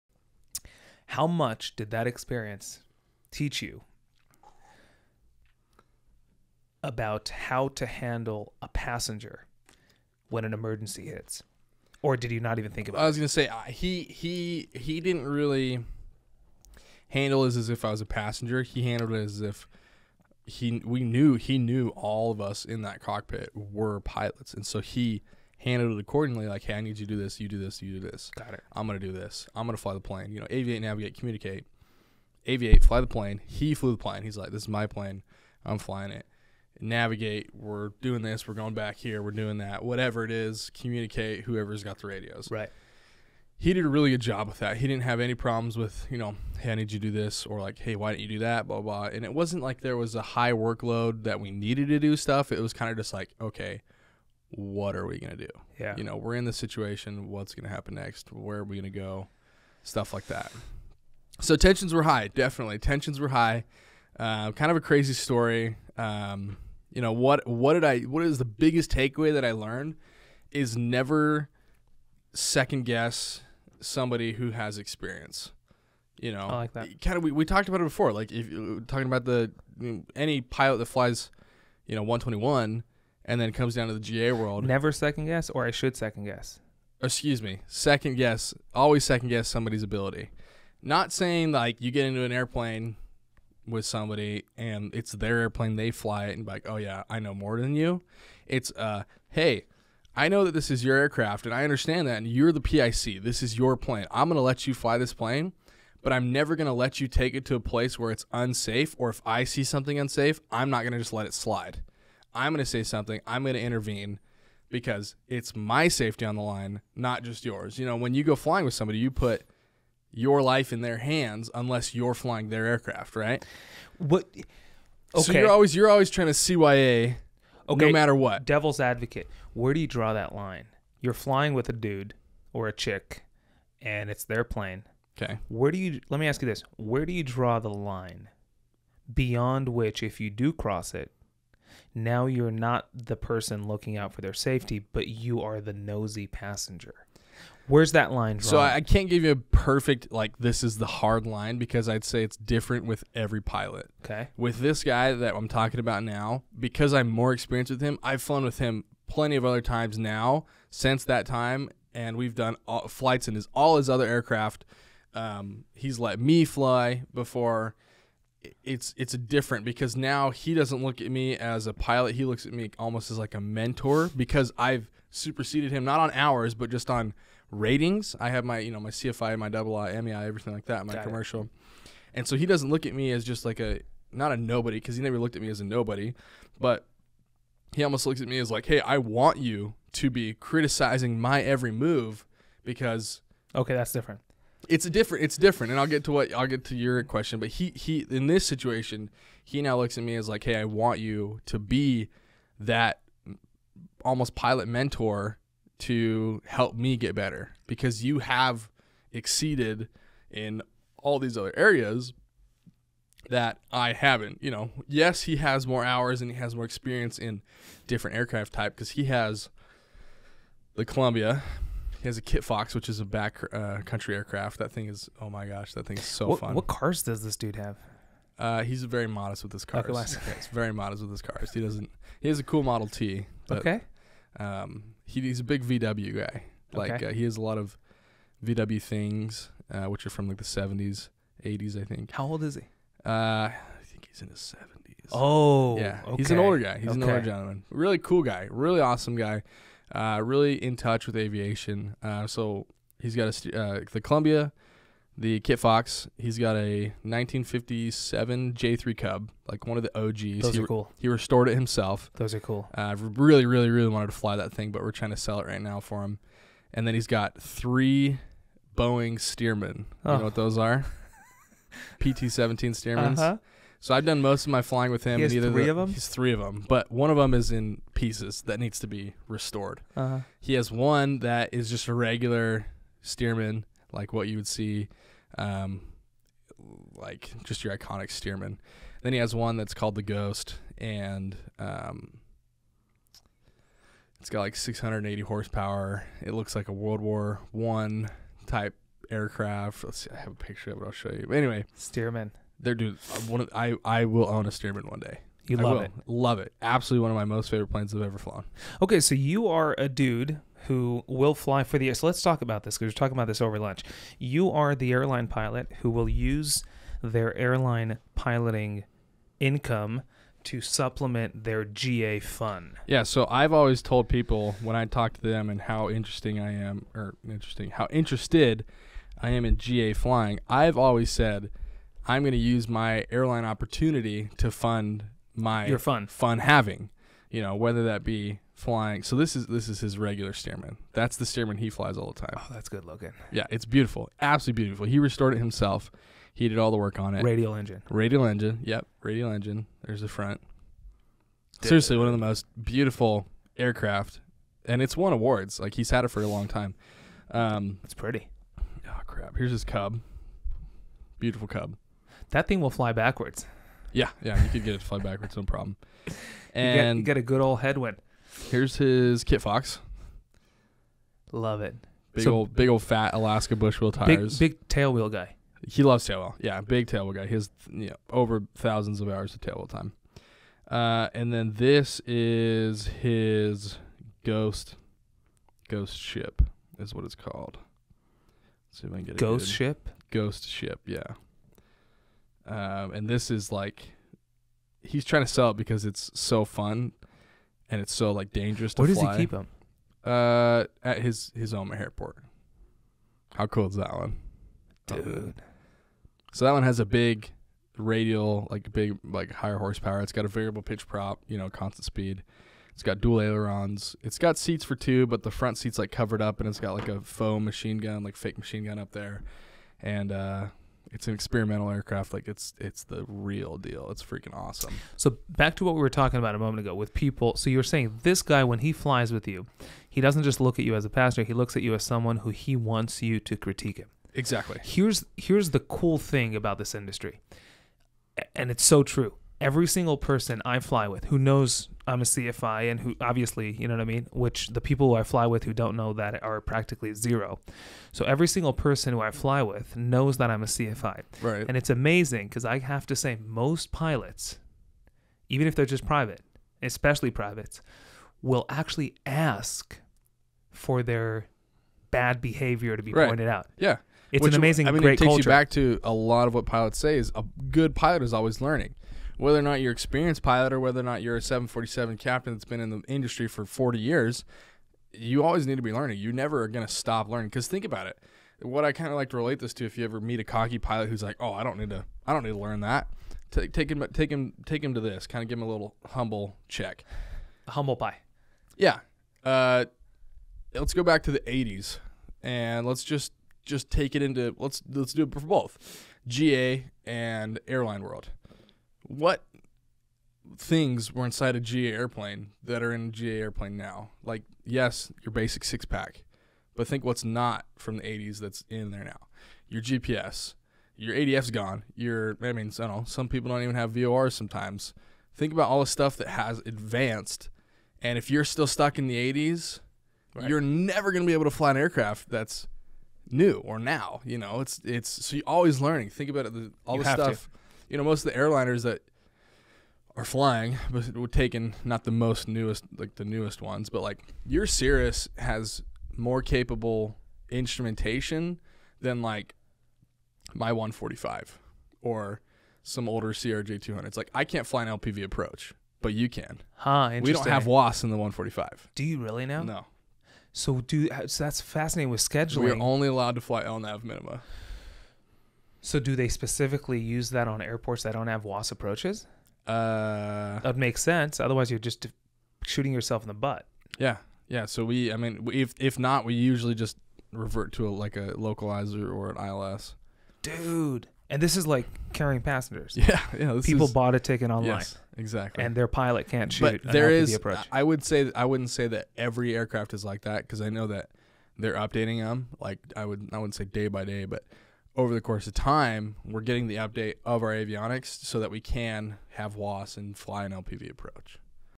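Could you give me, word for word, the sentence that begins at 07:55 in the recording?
You never are going to stop learning.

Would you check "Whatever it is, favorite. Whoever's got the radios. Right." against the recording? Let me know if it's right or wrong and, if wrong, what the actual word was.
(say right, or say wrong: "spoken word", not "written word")
wrong: "communicate", not "favorite".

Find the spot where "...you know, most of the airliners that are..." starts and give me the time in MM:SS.
08:47.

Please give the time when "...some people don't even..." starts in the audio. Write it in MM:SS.
08:32.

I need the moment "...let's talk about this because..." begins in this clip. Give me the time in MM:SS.
05:12.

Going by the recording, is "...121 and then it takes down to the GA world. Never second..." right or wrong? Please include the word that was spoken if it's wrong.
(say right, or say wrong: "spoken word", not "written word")
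wrong: "comes", not "takes".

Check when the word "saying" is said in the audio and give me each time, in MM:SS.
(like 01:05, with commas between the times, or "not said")
01:31, 07:07.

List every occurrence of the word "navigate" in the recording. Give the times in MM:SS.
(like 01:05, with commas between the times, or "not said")
00:30, 00:36.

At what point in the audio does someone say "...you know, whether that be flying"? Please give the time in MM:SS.
05:37.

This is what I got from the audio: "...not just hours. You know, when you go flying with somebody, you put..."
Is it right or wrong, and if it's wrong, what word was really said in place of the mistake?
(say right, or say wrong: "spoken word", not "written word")
wrong: "yours", not "hours".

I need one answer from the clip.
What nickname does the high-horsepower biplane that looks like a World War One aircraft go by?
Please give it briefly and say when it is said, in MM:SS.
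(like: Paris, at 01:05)
the Ghost, at 04:49.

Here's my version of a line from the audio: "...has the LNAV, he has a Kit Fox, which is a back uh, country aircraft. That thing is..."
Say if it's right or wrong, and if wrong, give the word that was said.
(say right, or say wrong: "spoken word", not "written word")
wrong: "Columbia", not "LNAV".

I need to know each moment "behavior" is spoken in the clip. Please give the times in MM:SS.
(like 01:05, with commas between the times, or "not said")
07:42.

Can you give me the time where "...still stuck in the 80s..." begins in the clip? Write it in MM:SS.
08:38.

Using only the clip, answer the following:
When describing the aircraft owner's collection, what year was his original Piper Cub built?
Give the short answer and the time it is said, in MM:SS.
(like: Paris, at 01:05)
1957, at 04:17.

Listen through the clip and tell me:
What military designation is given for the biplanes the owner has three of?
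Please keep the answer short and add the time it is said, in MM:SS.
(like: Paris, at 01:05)
PT-17, at 04:31.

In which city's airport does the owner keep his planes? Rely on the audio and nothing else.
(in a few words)
Omaha.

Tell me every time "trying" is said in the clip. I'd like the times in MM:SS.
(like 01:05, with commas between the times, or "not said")
02:06, 04:24, 06:35.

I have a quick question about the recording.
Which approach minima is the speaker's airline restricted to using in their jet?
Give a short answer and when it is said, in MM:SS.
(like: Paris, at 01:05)
LNAV, at 09:13.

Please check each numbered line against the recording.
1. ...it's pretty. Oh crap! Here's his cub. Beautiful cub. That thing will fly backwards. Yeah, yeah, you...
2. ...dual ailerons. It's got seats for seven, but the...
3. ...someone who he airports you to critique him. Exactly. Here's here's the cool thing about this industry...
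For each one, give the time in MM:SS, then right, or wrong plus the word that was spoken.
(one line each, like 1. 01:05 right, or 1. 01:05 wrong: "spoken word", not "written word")
1. 05:57 right
2. 06:52 wrong: "two", not "seven"
3. 07:11 wrong: "wants", not "airports".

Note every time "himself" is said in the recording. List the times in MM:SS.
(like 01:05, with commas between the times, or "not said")
04:21, 05:45.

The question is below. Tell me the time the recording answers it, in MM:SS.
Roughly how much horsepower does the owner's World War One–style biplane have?
04:54.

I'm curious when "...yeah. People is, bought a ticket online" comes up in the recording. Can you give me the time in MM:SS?
09:33.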